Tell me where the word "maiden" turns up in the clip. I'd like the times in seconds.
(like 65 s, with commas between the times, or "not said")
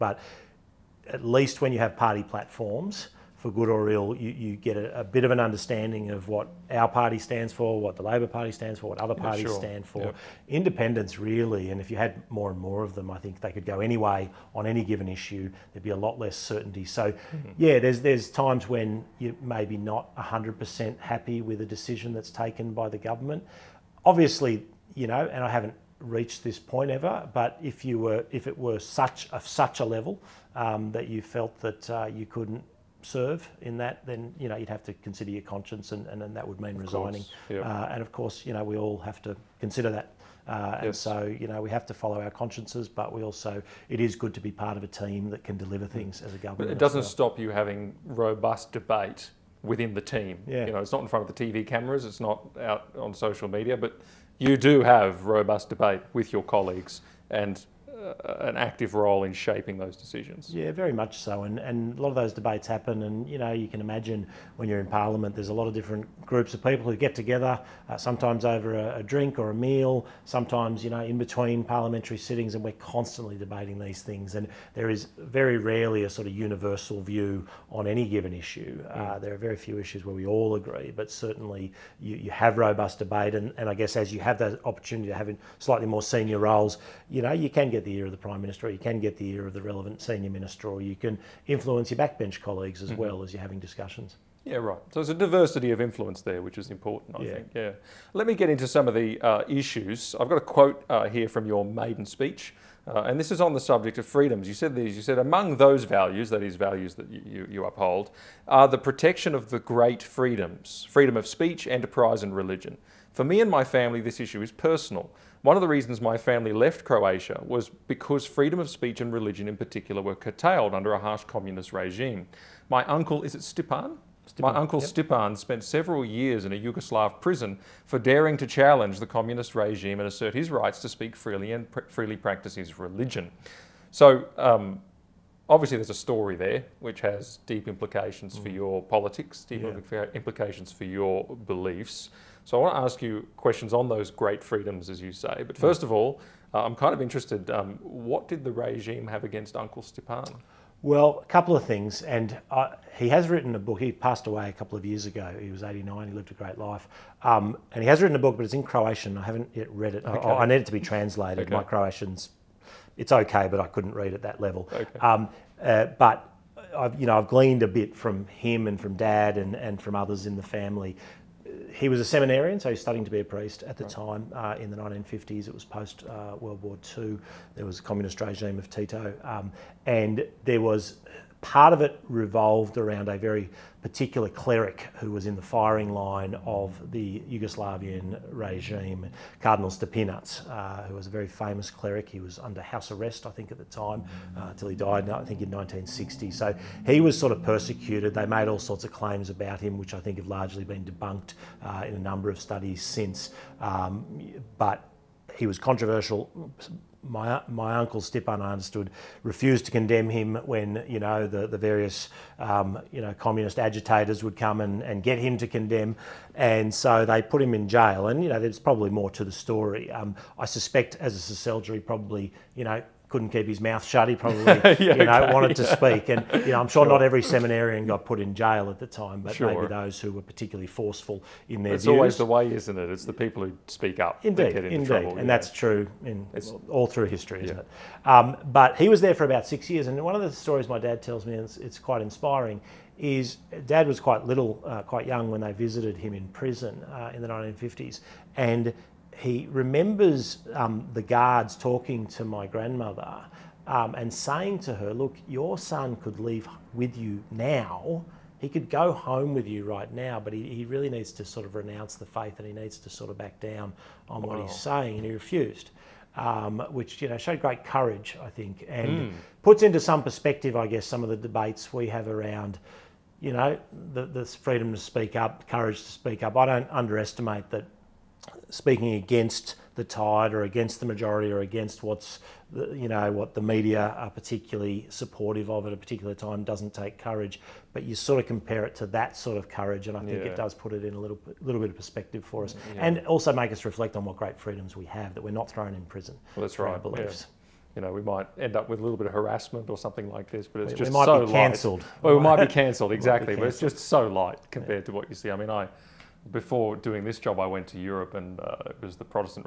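101 s.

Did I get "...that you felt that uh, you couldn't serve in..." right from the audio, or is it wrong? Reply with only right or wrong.
right.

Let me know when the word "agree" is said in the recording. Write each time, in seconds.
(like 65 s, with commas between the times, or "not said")
80 s.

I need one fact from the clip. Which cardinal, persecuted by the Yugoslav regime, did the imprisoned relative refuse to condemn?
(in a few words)
Cardinal Stepinac.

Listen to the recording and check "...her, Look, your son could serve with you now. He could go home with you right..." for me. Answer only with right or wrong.
wrong.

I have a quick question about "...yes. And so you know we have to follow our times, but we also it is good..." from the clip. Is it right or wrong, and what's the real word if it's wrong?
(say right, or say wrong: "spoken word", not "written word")
wrong: "consciences", not "times".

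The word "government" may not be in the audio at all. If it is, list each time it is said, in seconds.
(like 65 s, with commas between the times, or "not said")
22 s, 46 s.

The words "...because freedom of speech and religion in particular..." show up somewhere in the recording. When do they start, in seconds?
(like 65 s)
117 s.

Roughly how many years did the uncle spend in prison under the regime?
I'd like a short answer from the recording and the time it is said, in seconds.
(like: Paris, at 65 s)
6 years, at 239 s.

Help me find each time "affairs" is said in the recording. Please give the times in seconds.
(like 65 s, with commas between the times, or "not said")
not said.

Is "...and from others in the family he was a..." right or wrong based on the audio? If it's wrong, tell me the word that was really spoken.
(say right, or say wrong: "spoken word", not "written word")
right.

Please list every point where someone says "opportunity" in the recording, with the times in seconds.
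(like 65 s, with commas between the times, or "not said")
84 s.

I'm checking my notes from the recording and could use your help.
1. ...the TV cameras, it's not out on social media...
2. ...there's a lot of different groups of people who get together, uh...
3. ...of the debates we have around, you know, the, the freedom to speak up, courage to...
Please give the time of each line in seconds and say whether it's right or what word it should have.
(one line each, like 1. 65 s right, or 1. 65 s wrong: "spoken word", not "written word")
1. 51 s right
2. 65 s right
3. 271 s right.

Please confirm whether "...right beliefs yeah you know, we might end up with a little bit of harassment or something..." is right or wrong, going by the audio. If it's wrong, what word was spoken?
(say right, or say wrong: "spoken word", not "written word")
right.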